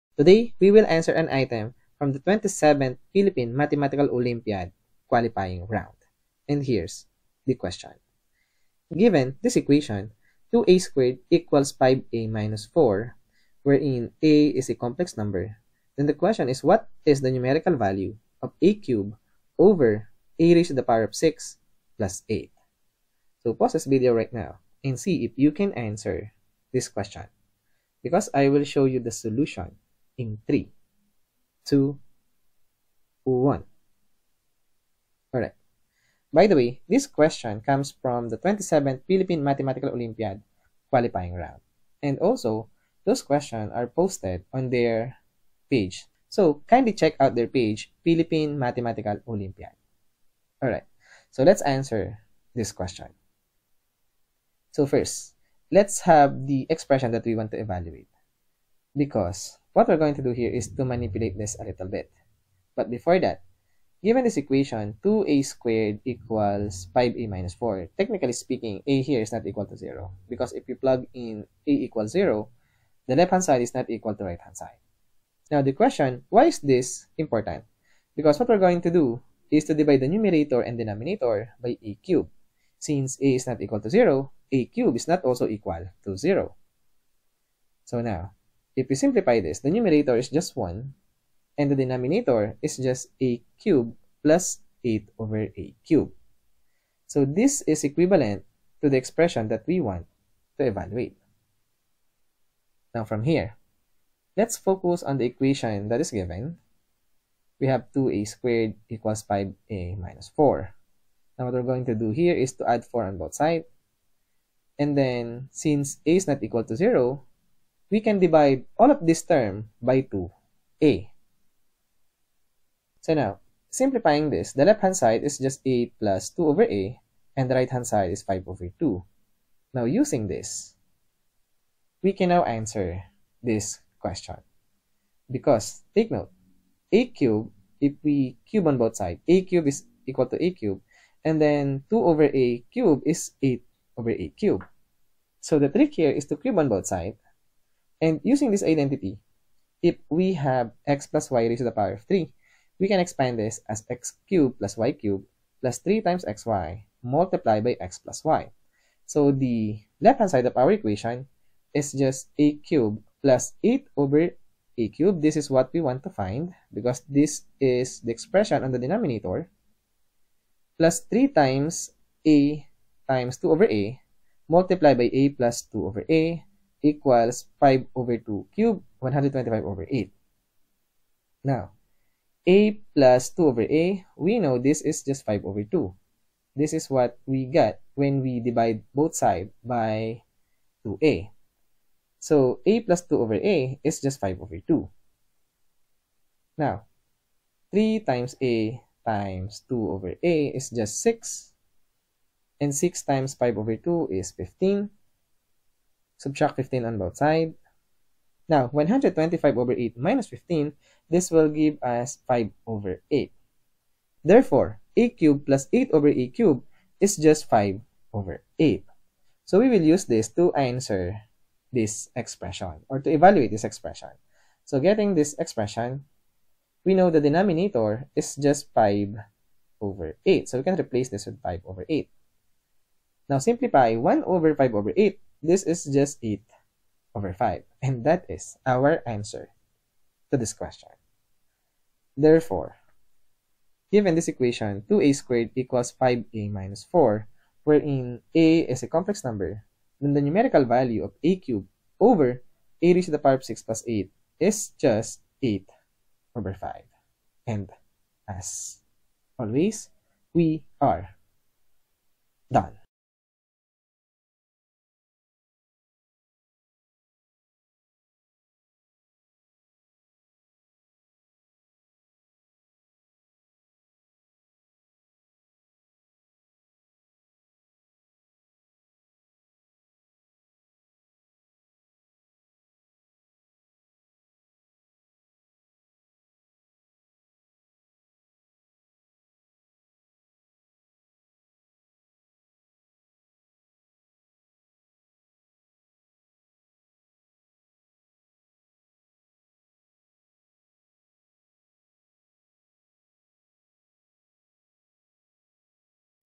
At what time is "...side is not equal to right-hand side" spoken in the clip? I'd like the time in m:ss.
1:13.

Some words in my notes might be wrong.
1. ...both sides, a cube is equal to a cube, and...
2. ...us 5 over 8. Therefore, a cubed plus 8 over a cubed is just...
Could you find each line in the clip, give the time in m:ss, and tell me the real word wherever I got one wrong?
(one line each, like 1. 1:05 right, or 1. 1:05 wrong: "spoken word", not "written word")
1. 2:18 right
2. 3:31 right.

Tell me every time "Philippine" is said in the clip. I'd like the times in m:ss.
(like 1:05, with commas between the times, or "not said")
0:03, 0:39, 0:48.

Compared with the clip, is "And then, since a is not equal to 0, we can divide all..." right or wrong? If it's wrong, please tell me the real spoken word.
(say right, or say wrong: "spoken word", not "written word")
right.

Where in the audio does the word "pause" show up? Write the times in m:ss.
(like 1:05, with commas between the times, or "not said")
0:23.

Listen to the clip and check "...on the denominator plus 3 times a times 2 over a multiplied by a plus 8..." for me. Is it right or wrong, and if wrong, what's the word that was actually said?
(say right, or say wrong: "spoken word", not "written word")
wrong: "2", not "8".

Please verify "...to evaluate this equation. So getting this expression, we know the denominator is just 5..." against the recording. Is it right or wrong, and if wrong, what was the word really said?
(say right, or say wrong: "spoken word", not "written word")
wrong: "expression", not "equation".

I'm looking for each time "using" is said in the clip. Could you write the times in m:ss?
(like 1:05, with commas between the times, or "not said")
2:09, 2:28.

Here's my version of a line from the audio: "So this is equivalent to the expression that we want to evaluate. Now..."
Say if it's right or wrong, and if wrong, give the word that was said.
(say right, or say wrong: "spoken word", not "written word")
right.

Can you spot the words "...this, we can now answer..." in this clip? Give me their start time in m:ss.
2:10.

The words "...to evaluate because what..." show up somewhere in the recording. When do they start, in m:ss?
0:57.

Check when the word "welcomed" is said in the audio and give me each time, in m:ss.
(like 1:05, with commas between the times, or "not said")
not said.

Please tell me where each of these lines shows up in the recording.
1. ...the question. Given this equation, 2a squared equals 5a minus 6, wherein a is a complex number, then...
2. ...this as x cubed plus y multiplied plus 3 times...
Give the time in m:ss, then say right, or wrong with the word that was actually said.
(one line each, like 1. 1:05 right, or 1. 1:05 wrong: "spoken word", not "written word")
1. 0:07 wrong: "4", not "6"
2. 2:33 wrong: "cubed", not "multiplied".